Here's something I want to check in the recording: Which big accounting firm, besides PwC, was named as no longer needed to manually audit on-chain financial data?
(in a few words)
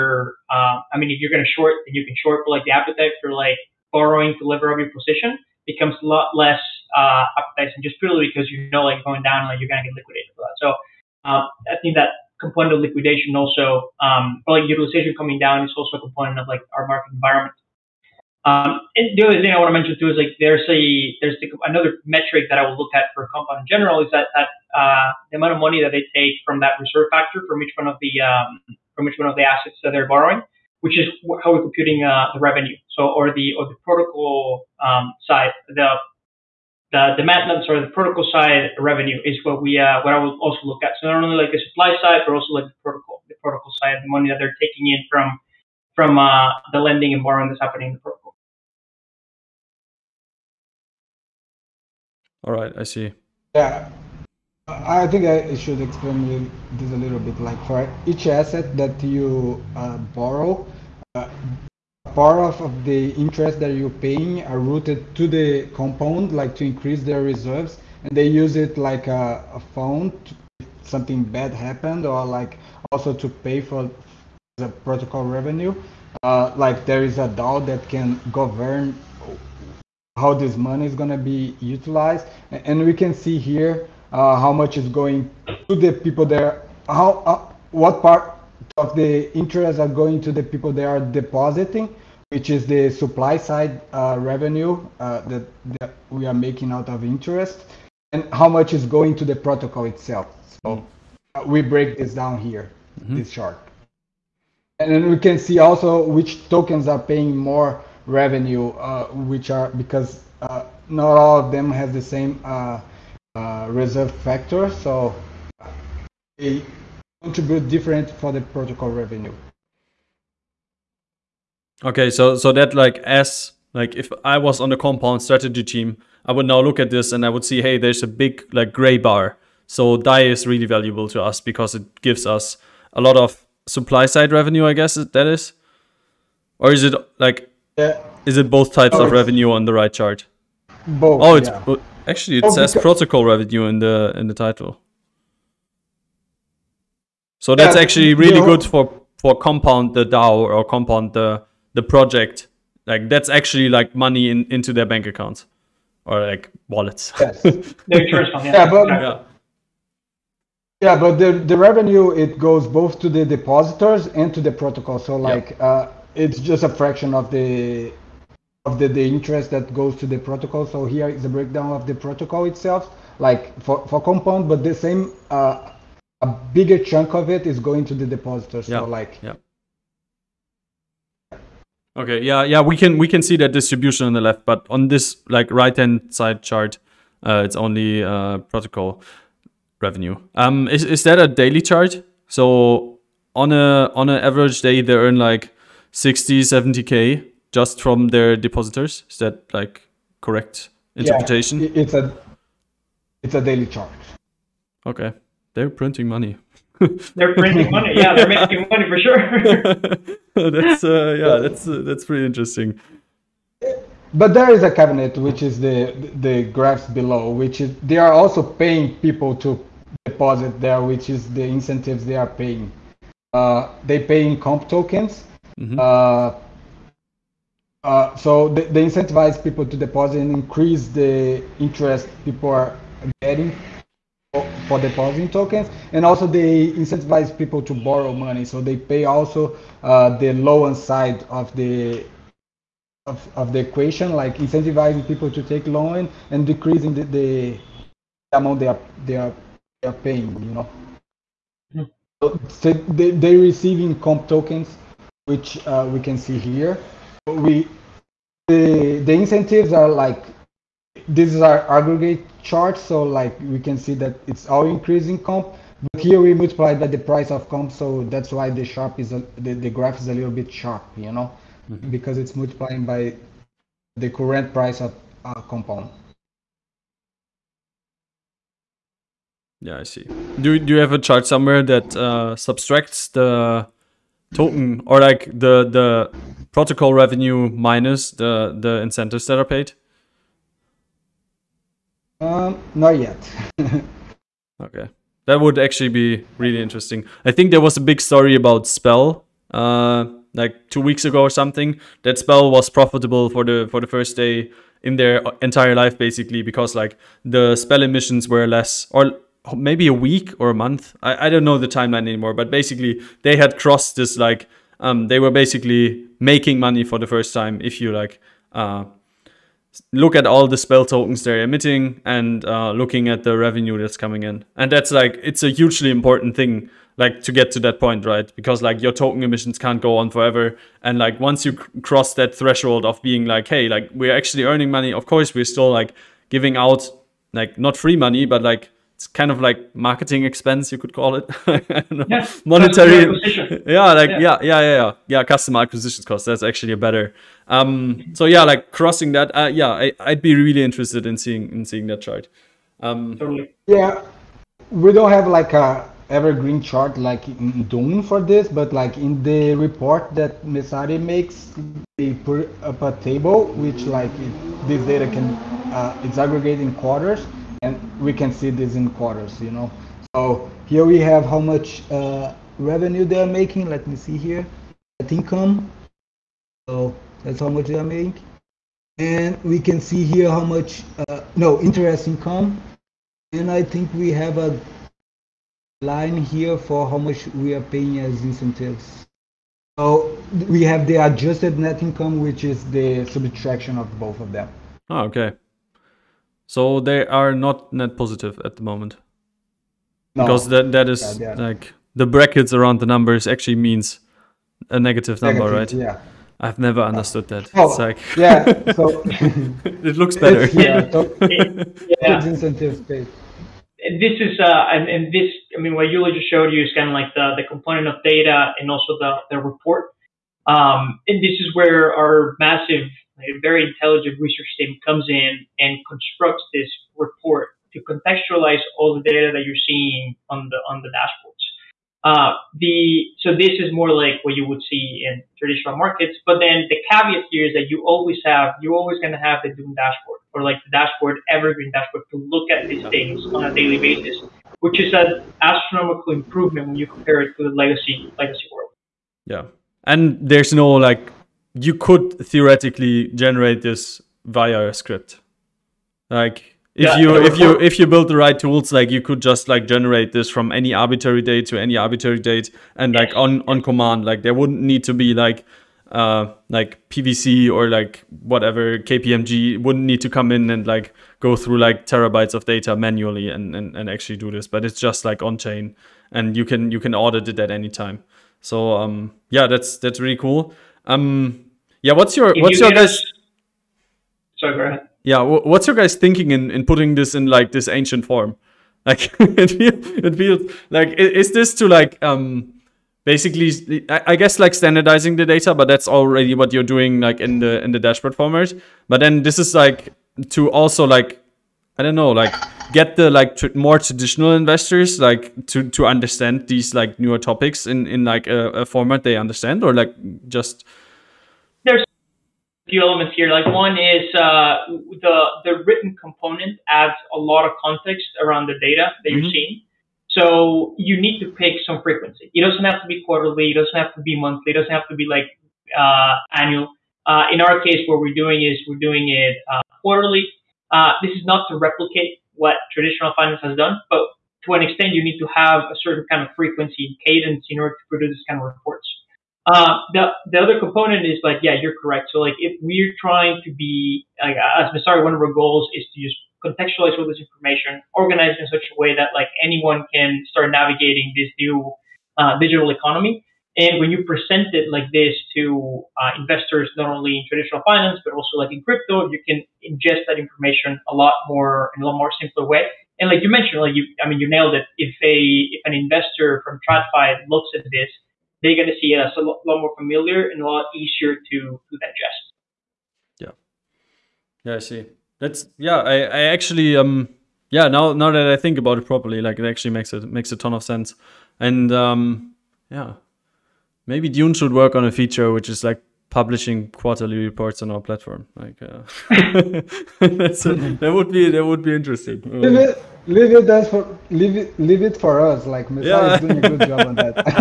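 KPMG.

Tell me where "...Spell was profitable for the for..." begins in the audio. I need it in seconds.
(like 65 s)
302 s.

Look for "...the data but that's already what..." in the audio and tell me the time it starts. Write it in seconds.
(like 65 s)
495 s.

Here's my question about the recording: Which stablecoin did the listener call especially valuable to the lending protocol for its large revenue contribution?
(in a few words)
DAI.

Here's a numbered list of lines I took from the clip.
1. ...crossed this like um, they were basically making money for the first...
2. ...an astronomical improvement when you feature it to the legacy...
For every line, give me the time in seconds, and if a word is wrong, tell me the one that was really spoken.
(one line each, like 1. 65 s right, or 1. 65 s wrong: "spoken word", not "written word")
1. 313 s right
2. 444 s wrong: "compare", not "feature".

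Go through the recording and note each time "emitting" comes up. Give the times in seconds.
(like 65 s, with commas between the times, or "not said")
321 s.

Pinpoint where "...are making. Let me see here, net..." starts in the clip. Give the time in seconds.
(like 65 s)
373 s.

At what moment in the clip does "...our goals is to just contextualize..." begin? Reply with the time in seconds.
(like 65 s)
545 s.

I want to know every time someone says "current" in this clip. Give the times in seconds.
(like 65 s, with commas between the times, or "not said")
274 s.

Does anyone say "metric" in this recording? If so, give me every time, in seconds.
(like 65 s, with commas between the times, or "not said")
22 s.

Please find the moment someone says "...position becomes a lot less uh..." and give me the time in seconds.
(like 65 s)
4 s.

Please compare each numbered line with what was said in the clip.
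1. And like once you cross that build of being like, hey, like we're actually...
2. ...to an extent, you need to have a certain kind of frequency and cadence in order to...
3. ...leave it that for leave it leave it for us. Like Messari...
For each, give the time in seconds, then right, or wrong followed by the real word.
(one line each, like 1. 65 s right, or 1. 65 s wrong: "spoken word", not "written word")
1. 330 s wrong: "threshold", not "build"
2. 534 s right
3. 593 s right.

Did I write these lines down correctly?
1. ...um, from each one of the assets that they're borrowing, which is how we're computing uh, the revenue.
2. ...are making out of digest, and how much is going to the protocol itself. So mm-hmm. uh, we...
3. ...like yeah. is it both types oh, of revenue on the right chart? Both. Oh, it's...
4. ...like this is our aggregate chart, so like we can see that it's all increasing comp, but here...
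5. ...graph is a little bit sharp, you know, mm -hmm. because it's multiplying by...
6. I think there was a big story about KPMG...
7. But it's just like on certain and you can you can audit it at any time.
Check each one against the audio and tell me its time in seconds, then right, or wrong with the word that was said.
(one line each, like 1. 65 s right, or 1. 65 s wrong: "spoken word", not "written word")
1. 28 s right
2. 96 s wrong: "interest", not "digest"
3. 137 s right
4. 259 s right
5. 269 s right
6. 297 s wrong: "Spell", not "KPMG"
7. 474 s wrong: "chain", not "certain".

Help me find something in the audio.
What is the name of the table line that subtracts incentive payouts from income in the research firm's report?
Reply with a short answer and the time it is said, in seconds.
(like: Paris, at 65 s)
adjusted net income, at 390 s.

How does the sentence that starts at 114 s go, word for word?
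So contribute different for the protocol revenue.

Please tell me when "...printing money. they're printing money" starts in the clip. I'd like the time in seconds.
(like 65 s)
205 s.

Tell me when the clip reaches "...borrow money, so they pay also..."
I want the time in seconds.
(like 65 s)
237 s.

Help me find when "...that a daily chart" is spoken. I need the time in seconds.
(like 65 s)
191 s.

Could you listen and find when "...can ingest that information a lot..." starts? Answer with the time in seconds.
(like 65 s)
559 s.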